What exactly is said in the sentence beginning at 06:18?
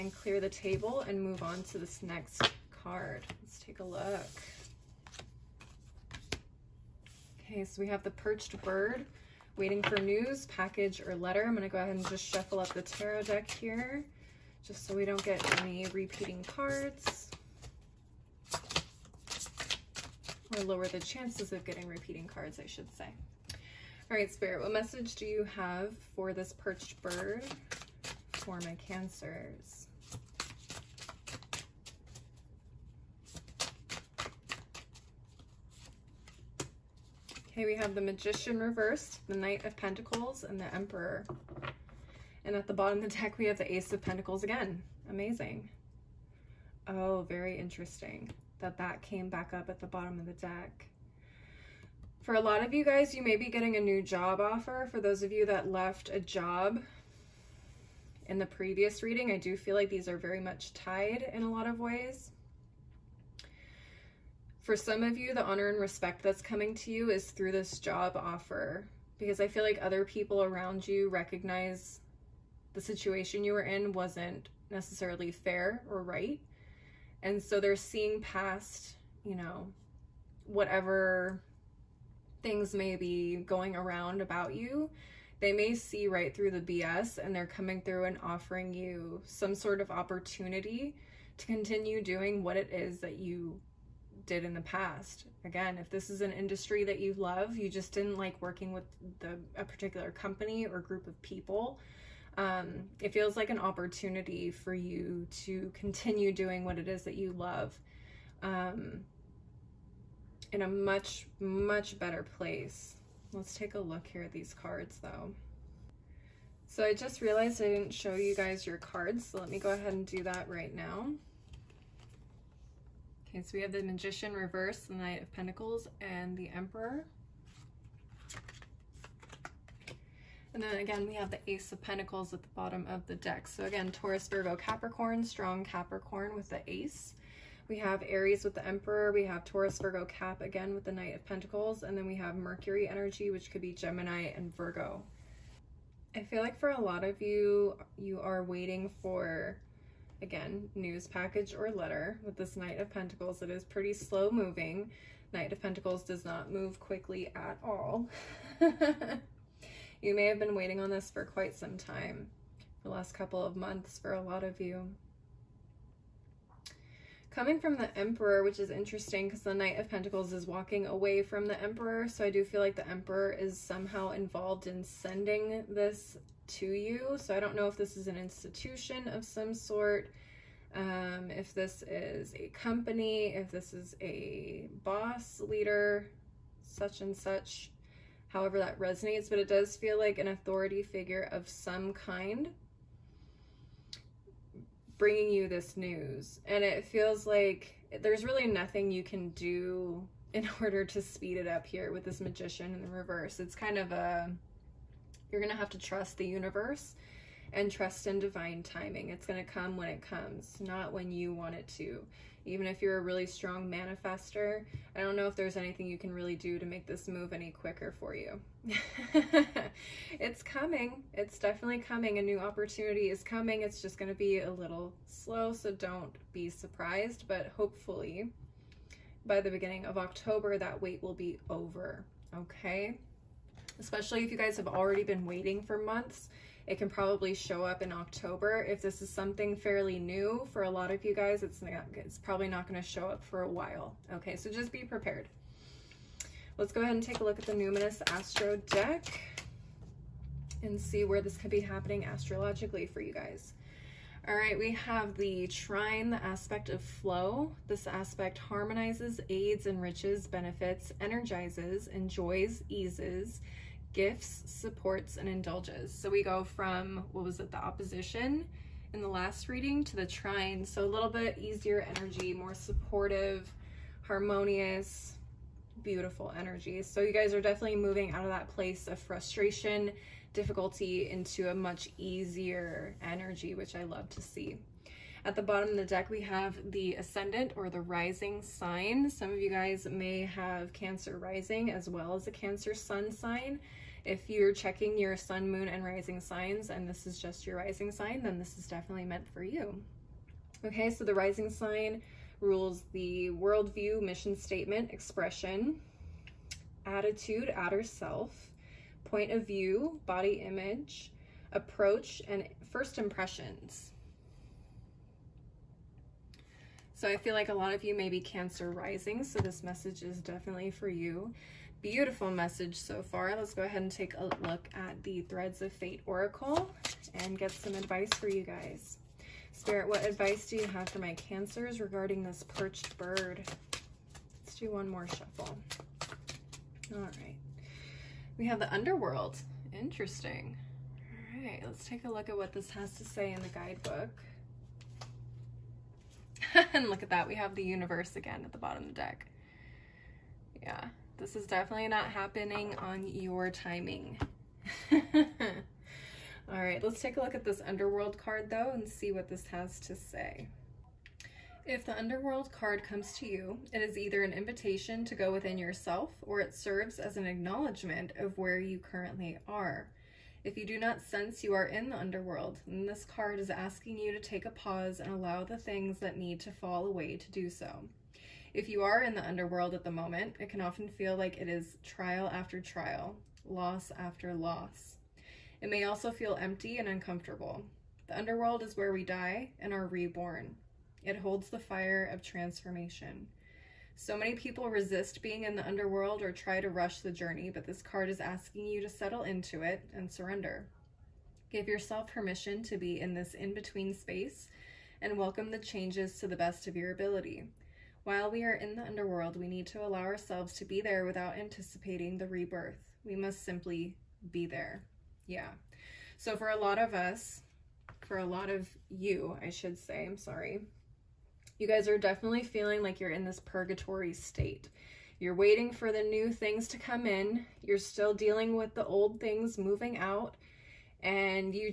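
If you are in the underworld at the moment, it can often feel like it is trial after trial, loss after loss.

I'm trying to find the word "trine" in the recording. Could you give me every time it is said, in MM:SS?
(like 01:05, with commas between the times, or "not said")
04:15, 04:30.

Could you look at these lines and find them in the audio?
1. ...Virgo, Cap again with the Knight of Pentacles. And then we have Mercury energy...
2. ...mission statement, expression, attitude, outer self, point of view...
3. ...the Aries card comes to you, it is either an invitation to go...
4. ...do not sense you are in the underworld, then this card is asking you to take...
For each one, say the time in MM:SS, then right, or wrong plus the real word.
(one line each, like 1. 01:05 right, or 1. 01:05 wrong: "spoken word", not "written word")
1. 02:19 right
2. 05:04 right
3. 06:01 wrong: "Underworld", not "Aries"
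4. 06:10 right.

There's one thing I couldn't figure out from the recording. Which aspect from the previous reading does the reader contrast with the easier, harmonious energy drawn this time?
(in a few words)
Opposition.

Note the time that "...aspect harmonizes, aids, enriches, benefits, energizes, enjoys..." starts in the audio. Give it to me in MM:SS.
04:17.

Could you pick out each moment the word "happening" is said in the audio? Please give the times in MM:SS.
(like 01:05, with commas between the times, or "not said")
04:11, 05:52.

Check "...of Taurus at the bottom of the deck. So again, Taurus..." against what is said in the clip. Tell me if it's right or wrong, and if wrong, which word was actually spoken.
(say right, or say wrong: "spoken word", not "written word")
wrong: "Pentacles", not "Taurus".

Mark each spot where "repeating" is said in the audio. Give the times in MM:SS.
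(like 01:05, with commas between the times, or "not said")
00:15, 00:21.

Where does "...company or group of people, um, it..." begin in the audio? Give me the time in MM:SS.
01:40.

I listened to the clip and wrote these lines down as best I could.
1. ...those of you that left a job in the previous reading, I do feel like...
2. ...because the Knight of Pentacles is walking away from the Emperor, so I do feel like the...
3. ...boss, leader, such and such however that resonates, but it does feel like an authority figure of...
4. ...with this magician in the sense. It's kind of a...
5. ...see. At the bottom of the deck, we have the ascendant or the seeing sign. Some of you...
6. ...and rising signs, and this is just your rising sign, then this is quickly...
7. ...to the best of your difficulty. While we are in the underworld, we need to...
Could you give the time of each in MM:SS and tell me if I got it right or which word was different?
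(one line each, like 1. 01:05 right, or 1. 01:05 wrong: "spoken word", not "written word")
1. 00:55 right
2. 02:49 right
3. 03:04 right
4. 03:21 wrong: "reverse", not "sense"
5. 04:44 wrong: "rising", not "seeing"
6. 04:55 wrong: "definitely", not "quickly"
7. 06:46 wrong: "ability", not "difficulty".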